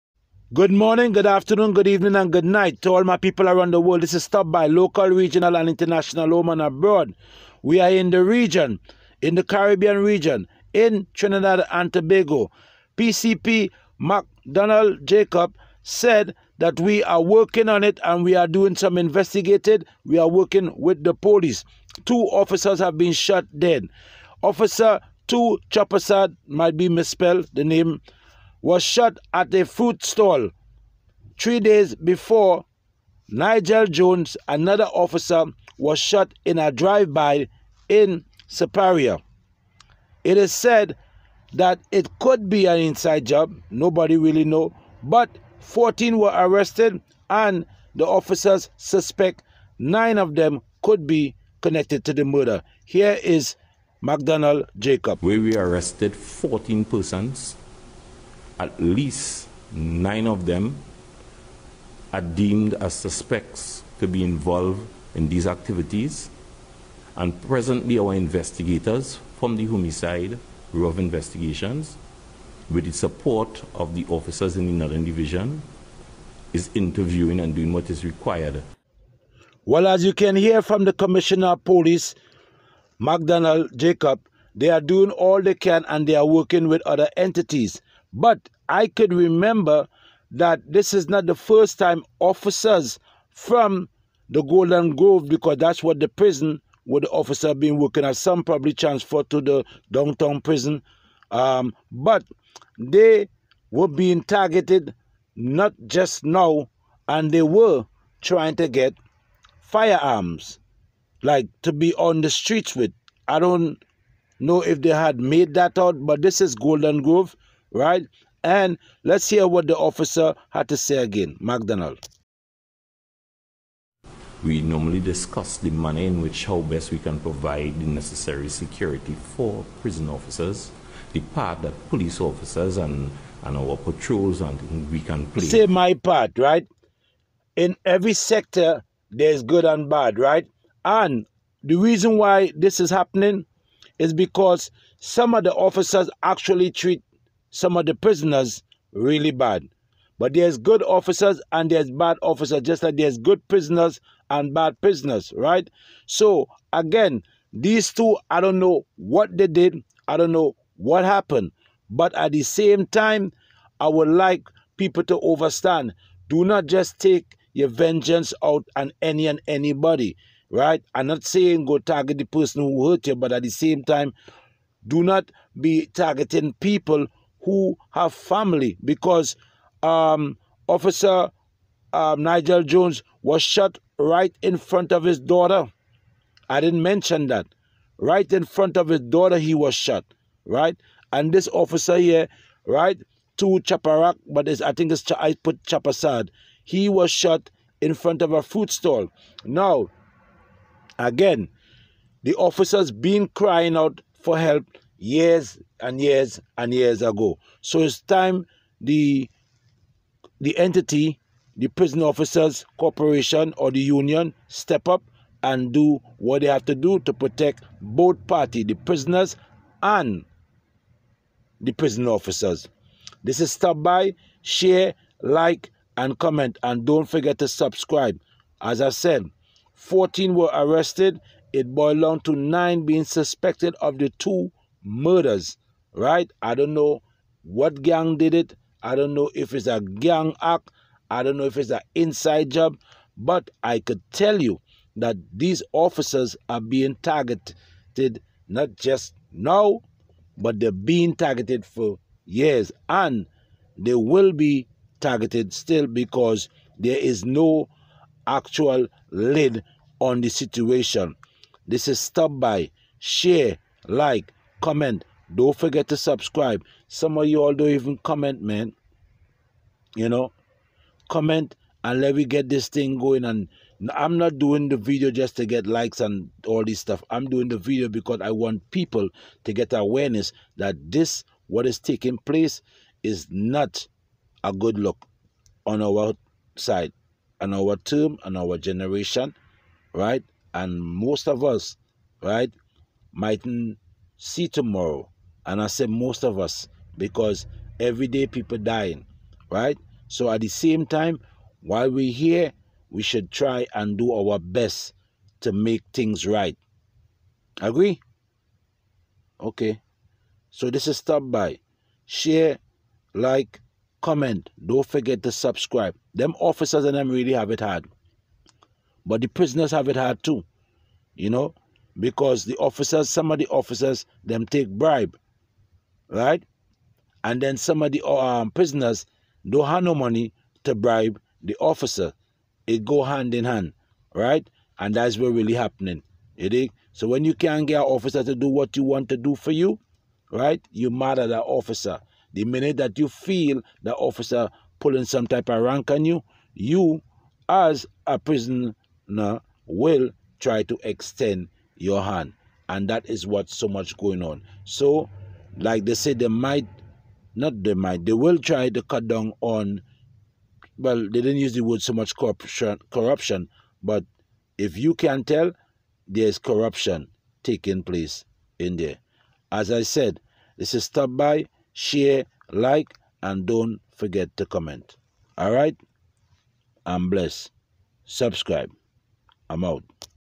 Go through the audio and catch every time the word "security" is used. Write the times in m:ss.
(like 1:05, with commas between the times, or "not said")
2:08.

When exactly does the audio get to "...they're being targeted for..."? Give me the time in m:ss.
4:10.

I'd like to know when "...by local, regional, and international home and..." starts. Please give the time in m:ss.
0:04.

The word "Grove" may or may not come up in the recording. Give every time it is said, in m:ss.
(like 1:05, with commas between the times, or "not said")
1:34, 1:57.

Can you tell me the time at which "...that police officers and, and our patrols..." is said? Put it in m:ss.
2:11.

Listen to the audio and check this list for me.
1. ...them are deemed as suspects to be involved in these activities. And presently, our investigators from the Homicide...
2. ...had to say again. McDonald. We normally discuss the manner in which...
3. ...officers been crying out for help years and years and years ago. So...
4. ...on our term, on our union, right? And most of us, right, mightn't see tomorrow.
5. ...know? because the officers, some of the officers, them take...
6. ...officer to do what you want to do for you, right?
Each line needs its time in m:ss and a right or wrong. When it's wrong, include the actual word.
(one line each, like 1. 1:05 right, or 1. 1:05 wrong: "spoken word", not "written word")
1. 1:00 right
2. 2:00 right
3. 3:22 right
4. 4:47 wrong: "generation", not "union"
5. 5:21 right
6. 5:37 right.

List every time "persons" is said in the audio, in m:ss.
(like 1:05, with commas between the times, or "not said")
0:56, 2:52.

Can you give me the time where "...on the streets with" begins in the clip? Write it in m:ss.
1:51.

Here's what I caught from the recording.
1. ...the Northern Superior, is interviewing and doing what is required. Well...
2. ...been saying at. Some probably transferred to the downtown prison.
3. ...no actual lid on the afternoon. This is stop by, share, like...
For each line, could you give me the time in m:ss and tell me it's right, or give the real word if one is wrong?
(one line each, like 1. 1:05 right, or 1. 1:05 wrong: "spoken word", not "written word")
1. 1:14 wrong: "Division", not "Superior"
2. 1:37 wrong: "working", not "saying"
3. 4:17 wrong: "situation", not "afternoon".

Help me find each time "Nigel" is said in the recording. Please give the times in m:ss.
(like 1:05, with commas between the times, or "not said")
0:33, 3:02.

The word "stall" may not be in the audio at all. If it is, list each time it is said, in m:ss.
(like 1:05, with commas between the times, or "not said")
0:30, 3:18.